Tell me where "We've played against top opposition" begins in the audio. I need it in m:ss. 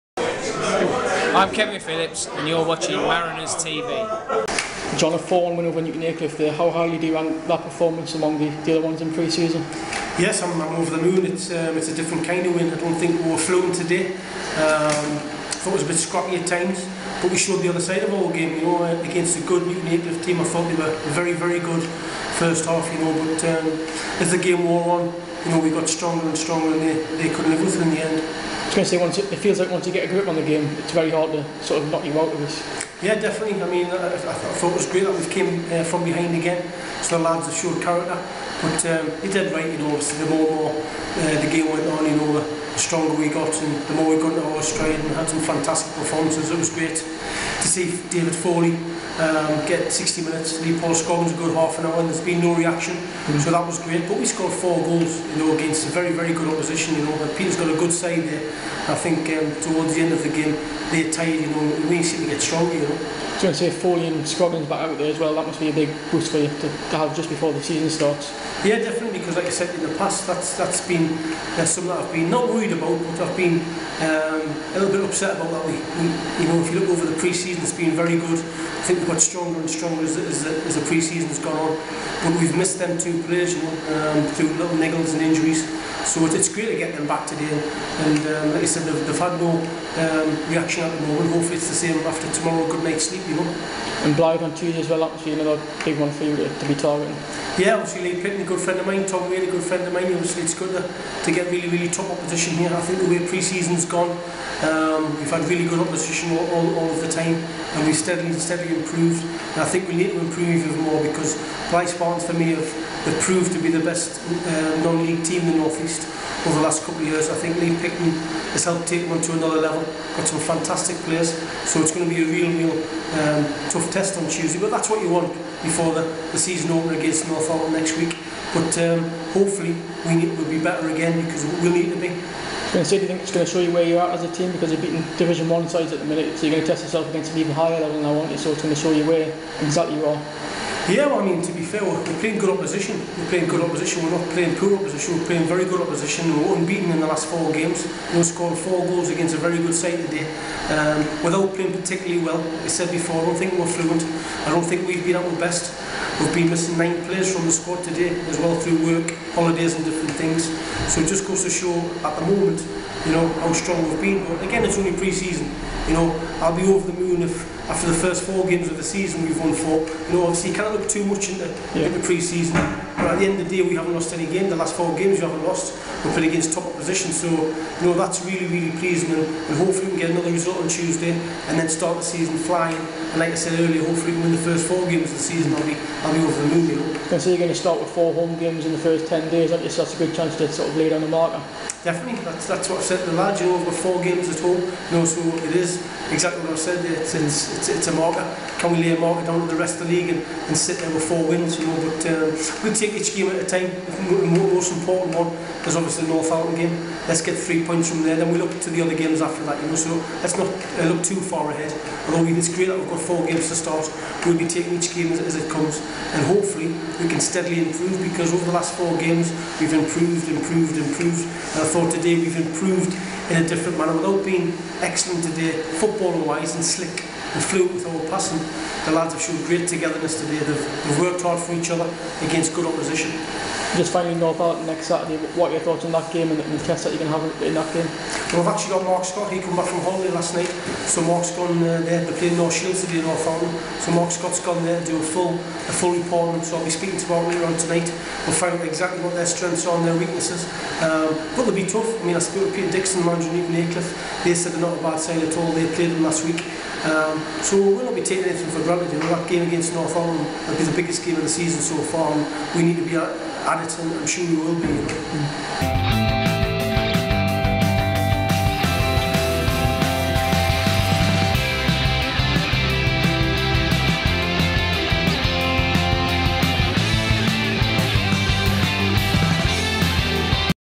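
2:56.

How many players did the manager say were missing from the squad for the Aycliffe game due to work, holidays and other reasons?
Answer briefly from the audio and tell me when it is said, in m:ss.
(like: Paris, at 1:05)
9, at 2:36.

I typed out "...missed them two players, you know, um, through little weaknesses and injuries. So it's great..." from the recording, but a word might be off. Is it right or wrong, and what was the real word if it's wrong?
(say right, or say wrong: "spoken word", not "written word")
wrong: "niggles", not "weaknesses".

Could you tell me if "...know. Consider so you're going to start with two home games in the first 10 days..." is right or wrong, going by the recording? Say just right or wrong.
wrong.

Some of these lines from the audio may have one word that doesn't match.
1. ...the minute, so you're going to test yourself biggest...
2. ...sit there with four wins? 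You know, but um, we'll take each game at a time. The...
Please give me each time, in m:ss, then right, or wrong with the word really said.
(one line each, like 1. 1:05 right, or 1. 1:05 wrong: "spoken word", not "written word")
1. 2:15 wrong: "against", not "biggest"
2. 3:20 right.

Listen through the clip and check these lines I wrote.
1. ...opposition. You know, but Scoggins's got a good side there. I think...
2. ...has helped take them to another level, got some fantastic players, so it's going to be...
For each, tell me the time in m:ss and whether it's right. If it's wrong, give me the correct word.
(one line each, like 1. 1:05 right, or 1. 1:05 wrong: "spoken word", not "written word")
1. 0:56 wrong: "Peter", not "Scoggins"
2. 1:58 right.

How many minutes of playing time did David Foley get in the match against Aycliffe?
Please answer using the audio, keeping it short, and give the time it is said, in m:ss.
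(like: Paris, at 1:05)
60, at 0:49.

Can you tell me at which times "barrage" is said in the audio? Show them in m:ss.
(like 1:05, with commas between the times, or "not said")
not said.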